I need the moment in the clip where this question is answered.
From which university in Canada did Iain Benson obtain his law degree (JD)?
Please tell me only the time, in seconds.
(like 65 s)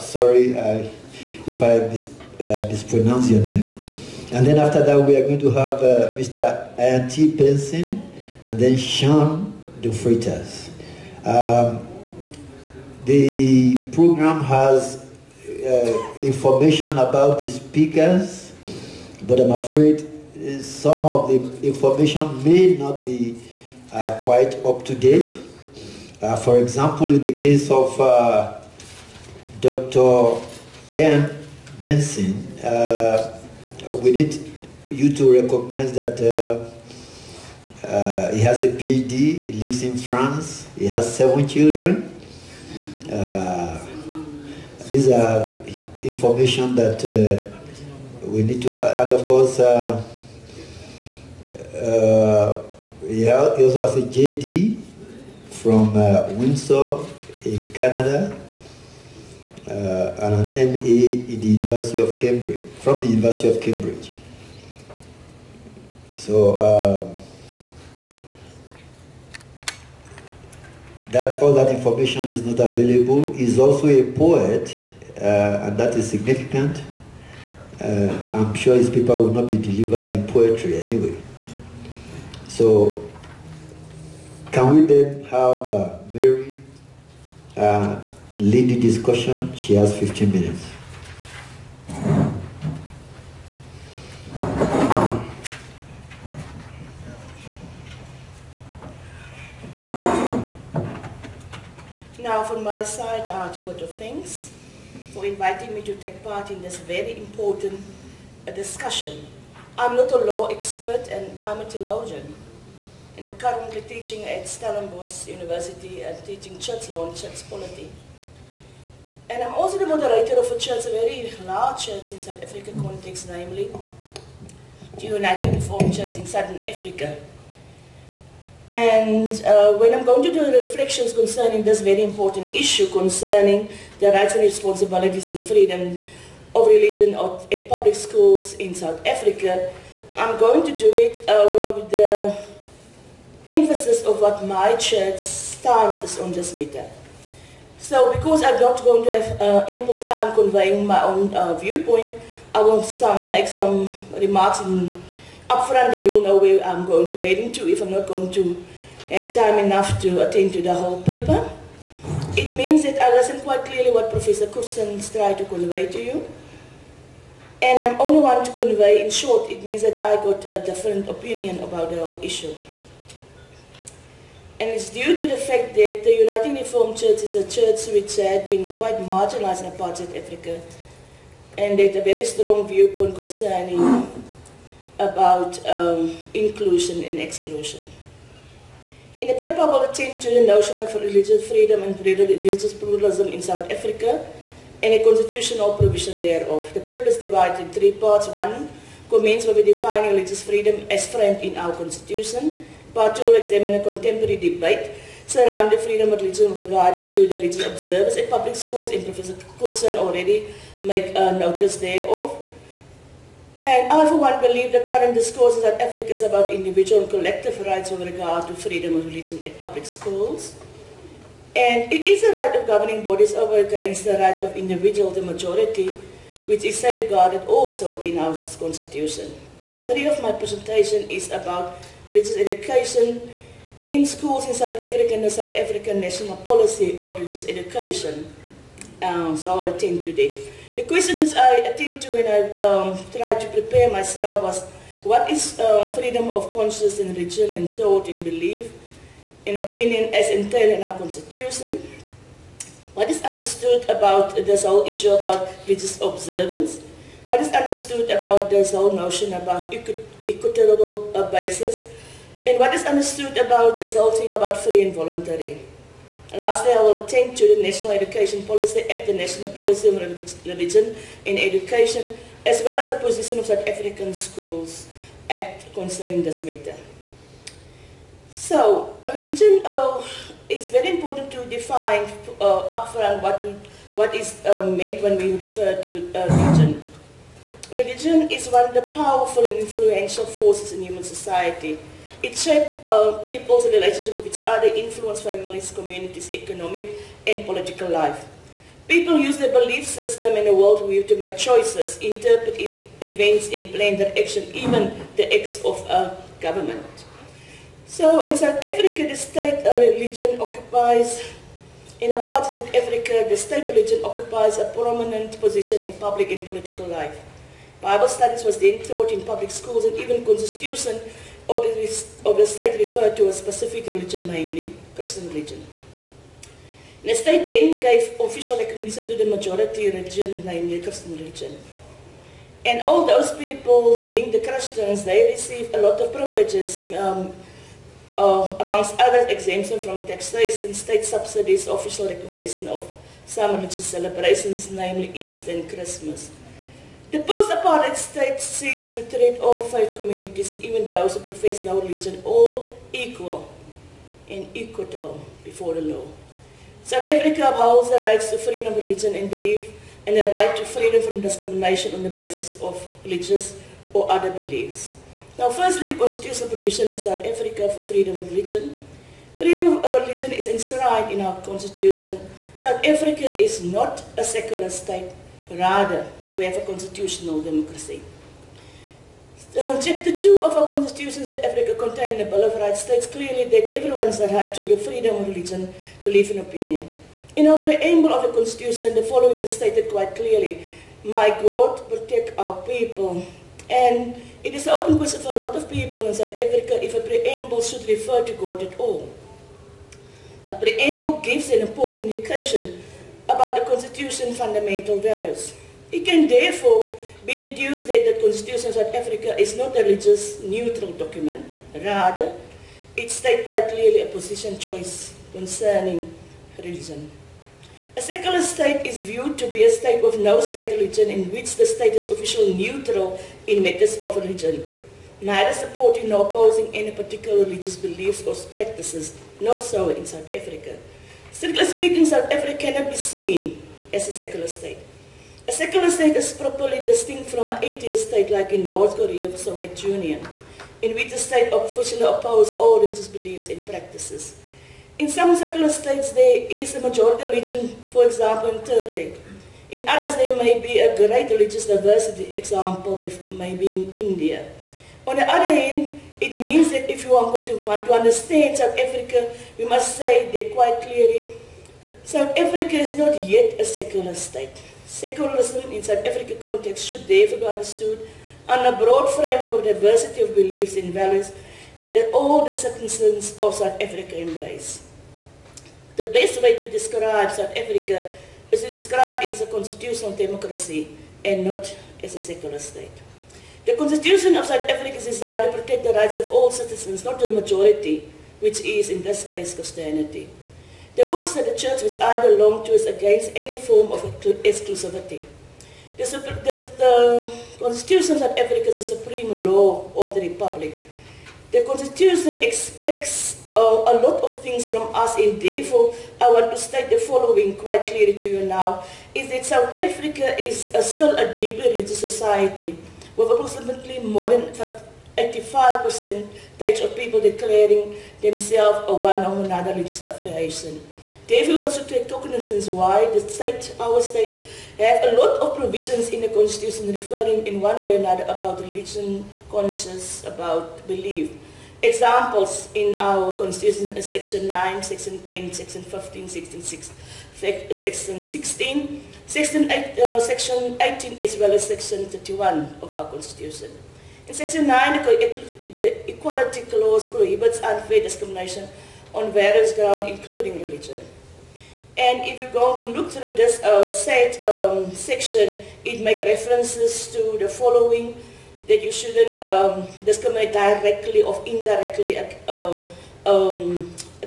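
56 s.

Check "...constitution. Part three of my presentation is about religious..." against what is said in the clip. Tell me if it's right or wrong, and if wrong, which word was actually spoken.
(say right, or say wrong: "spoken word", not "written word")
right.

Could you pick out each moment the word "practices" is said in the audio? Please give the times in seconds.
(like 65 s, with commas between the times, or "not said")
428 s, 443 s.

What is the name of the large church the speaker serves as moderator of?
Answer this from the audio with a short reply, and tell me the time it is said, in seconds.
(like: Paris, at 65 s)
United Reformed Church in Southern Africa, at 125 s.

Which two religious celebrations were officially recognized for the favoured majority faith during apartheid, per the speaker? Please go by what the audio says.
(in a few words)
Easter and Christmas.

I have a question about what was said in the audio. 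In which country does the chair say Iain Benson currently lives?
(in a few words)
France.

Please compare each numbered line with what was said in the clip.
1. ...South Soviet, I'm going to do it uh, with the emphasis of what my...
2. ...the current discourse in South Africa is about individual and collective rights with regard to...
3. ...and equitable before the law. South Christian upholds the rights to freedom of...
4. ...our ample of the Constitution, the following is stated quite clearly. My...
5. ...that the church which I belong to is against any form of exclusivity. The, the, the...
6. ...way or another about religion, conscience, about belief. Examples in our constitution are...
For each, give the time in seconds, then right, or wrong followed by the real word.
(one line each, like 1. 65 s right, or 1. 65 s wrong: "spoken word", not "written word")
1. 138 s wrong: "Africa", not "Soviet"
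2. 214 s right
3. 354 s wrong: "Africa", not "Christian"
4. 387 s wrong: "preamble", not "ample"
5. 491 s right
6. 527 s right.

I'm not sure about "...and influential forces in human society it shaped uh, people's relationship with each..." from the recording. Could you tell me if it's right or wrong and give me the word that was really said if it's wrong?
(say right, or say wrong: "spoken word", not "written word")
right.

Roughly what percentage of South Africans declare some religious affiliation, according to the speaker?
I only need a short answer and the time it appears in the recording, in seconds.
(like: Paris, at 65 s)
85 percent, at 515 s.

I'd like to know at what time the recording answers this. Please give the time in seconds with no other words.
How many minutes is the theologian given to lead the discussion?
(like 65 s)
89 s.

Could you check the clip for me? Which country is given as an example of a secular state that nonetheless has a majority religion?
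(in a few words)
Turkey.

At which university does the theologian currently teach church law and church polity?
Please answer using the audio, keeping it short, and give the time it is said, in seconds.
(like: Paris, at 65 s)
Stellenbosch University, at 114 s.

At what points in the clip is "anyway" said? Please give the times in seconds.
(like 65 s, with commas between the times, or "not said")
80 s.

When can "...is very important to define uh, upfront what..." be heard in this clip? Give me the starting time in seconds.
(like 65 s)
280 s.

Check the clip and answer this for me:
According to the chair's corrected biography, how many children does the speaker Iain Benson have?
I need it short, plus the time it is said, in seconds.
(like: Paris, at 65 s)
7, at 41 s.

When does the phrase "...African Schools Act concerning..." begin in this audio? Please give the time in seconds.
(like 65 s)
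273 s.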